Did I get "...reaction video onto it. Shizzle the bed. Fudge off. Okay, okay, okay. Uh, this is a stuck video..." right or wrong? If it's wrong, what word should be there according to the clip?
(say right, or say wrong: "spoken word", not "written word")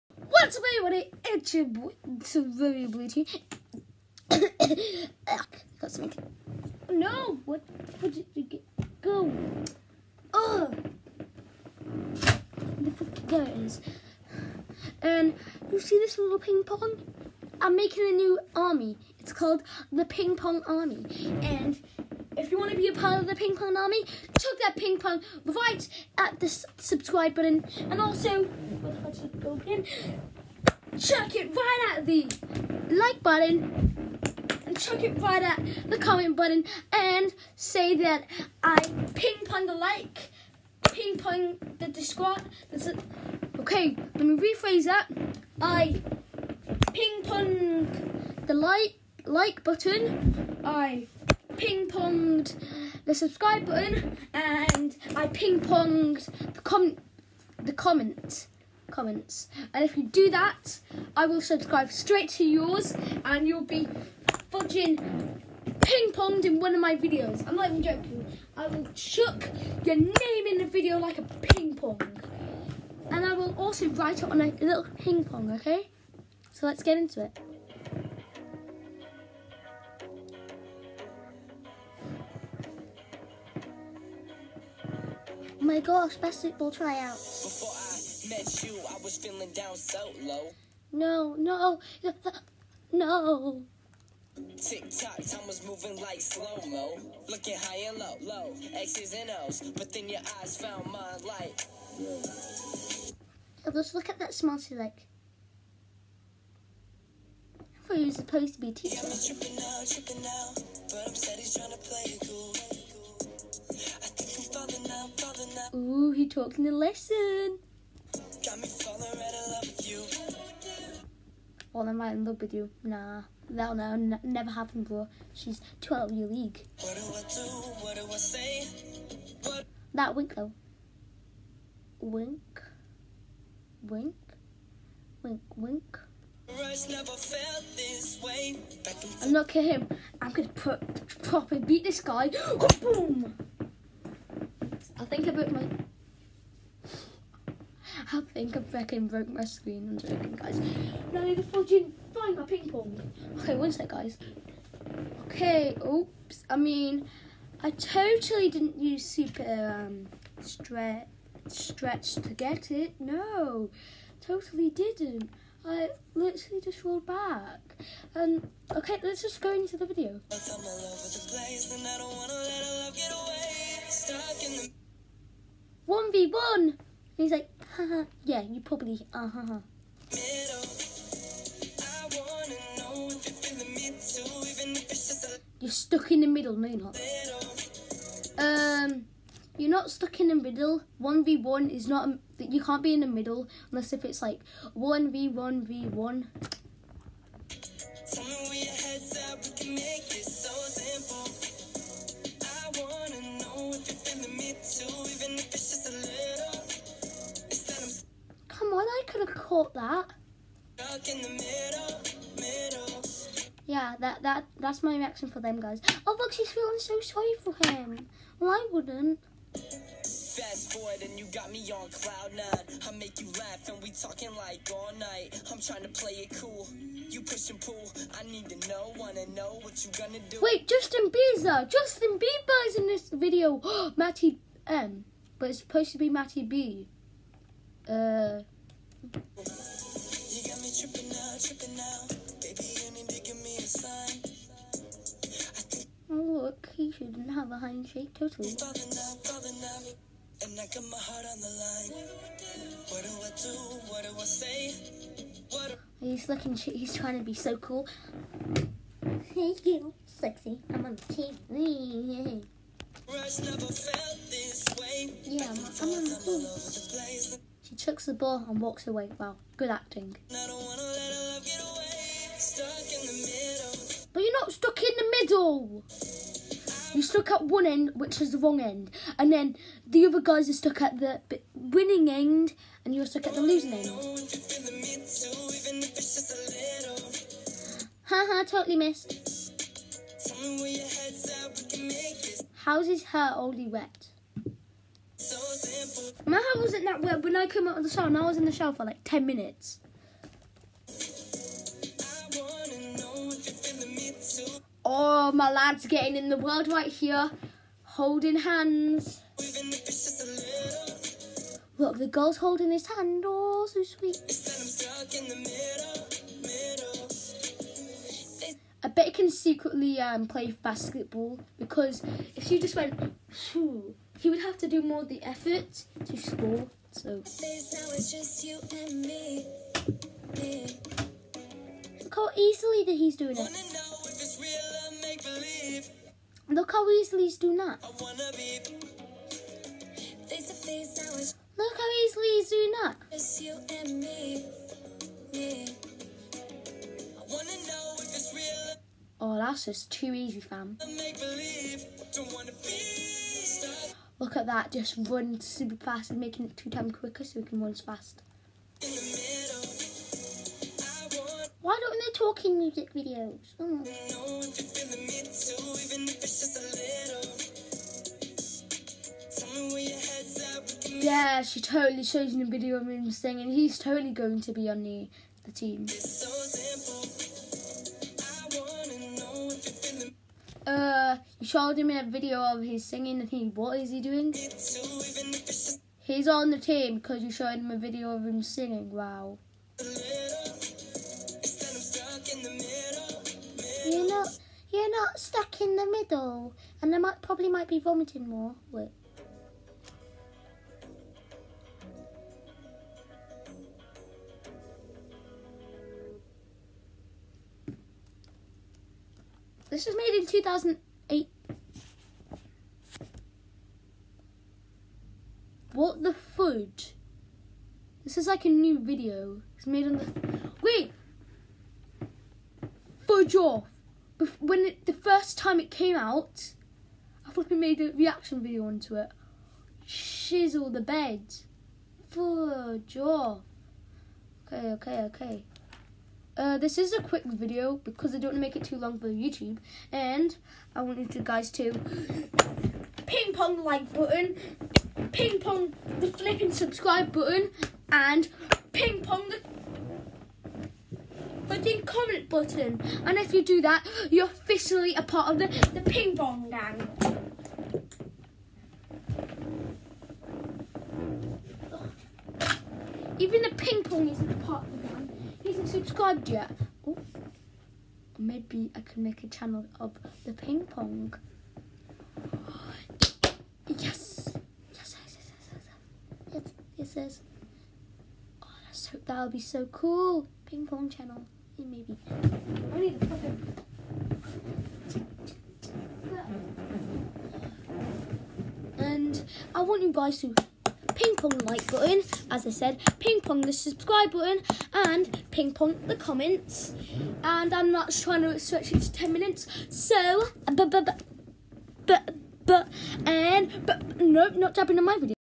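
wrong: "quick", not "stuck".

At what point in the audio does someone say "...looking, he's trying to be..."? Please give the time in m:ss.
4:16.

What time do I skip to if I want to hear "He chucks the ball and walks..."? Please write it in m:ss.
4:27.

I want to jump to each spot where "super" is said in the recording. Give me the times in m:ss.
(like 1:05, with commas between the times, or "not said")
2:39, 5:55.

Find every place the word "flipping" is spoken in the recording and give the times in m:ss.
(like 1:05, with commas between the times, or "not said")
7:07, 7:26, 7:31.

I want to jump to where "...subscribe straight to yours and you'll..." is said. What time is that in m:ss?
1:01.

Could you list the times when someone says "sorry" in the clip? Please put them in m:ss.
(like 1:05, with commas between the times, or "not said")
3:37.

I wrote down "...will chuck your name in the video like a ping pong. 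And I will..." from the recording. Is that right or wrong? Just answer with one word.
right.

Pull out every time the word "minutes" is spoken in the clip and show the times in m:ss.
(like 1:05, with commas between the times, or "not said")
4:59, 8:19.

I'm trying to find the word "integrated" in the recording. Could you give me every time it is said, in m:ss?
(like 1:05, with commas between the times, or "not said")
not said.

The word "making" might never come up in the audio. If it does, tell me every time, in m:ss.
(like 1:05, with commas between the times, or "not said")
0:17, 5:56.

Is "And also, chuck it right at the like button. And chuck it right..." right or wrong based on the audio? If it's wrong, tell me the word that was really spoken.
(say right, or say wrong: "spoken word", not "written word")
right.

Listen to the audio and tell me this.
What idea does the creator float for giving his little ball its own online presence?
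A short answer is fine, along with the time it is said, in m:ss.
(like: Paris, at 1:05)
Ping pong channel, at 8:00.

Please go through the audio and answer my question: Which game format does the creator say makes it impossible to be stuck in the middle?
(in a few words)
1v1v1.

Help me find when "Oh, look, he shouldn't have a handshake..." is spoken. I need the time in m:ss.
4:06.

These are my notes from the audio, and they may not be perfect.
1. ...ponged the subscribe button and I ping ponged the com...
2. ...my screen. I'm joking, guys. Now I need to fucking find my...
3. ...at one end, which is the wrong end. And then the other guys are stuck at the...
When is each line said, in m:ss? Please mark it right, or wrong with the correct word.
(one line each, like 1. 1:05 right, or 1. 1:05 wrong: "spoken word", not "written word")
1. 0:51 right
2. 2:29 right
3. 4:37 right.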